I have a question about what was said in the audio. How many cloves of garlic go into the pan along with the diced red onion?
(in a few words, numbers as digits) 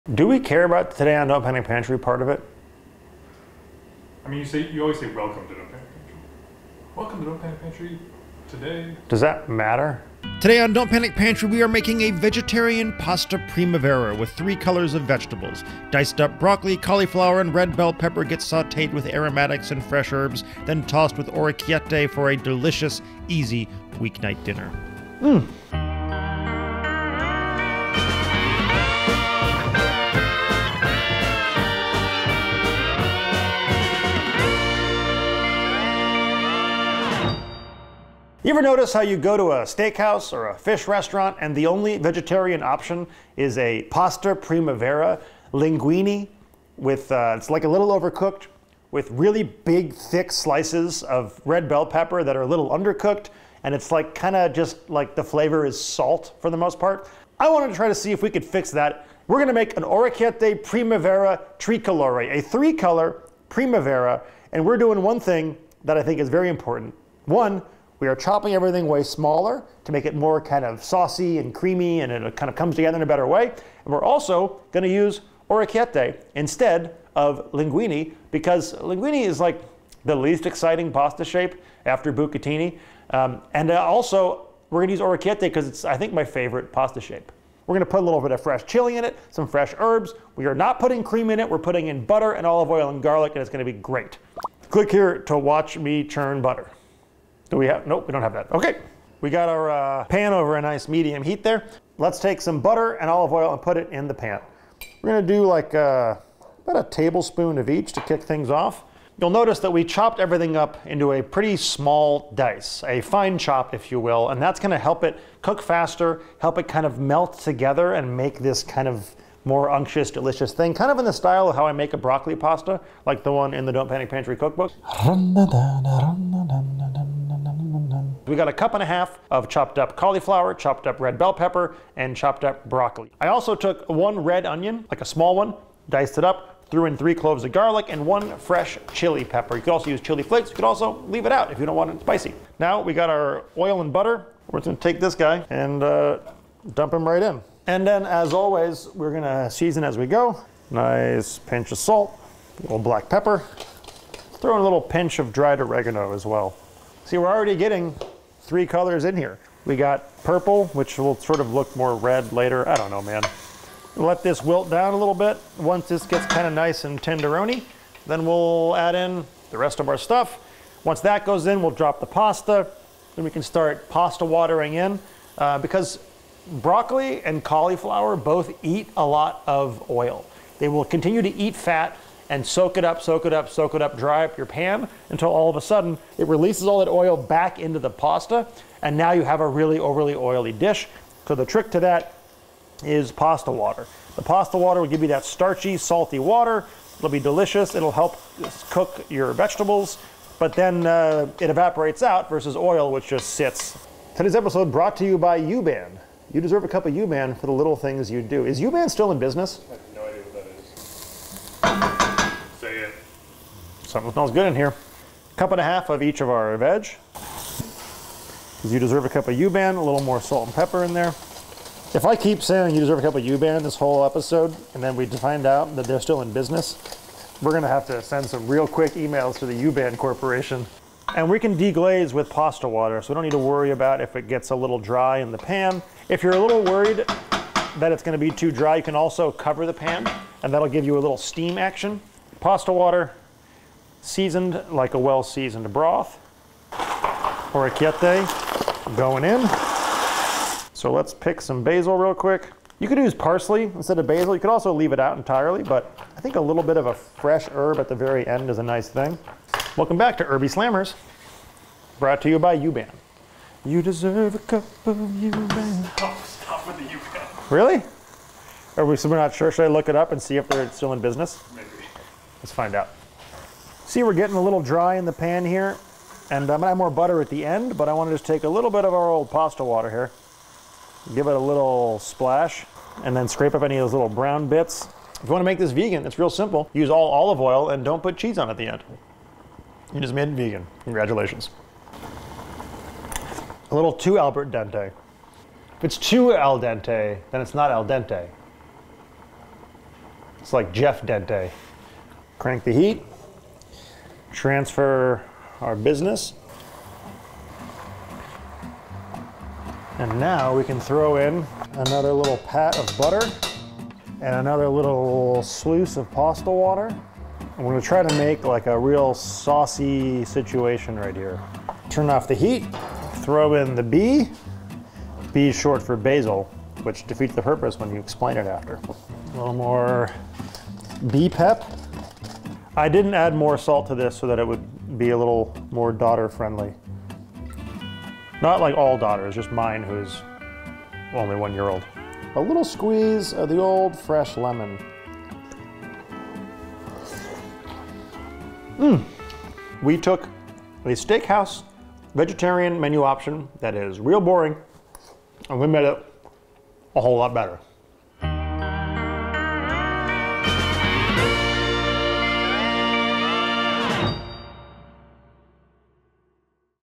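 3.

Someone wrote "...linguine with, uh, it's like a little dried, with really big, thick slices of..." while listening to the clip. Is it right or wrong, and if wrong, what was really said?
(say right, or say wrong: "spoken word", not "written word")
wrong: "overcooked", not "dried".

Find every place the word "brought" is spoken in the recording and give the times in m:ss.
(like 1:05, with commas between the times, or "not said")
3:24, 4:21.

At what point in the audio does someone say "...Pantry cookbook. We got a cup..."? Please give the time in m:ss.
2:04.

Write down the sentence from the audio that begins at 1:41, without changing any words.
Let's take some butter and olive oil and put it in the pan.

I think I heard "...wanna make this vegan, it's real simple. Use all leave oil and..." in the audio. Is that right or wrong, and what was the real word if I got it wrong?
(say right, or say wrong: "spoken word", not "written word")
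wrong: "olive", not "leave".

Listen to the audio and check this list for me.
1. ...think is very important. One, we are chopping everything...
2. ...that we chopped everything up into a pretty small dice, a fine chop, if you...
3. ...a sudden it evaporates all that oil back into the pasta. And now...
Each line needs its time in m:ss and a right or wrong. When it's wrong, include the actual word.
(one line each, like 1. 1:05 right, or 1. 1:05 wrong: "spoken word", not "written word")
1. 1:06 right
2. 1:49 right
3. 3:05 wrong: "releases", not "evaporates".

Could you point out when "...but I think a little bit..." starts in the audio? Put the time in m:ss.
4:15.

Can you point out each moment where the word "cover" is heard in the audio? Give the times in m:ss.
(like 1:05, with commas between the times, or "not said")
3:59.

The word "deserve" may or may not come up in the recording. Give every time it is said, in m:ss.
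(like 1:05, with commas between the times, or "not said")
3:26, 3:38, 3:42, 4:23.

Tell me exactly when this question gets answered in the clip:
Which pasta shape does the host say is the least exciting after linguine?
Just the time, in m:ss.
1:22.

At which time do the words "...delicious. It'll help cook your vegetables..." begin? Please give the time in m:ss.
3:17.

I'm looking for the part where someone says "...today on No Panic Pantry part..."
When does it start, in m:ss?
0:00.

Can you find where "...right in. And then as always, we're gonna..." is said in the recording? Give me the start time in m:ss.
2:27.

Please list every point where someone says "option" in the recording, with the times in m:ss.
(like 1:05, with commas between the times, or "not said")
0:42, 5:53.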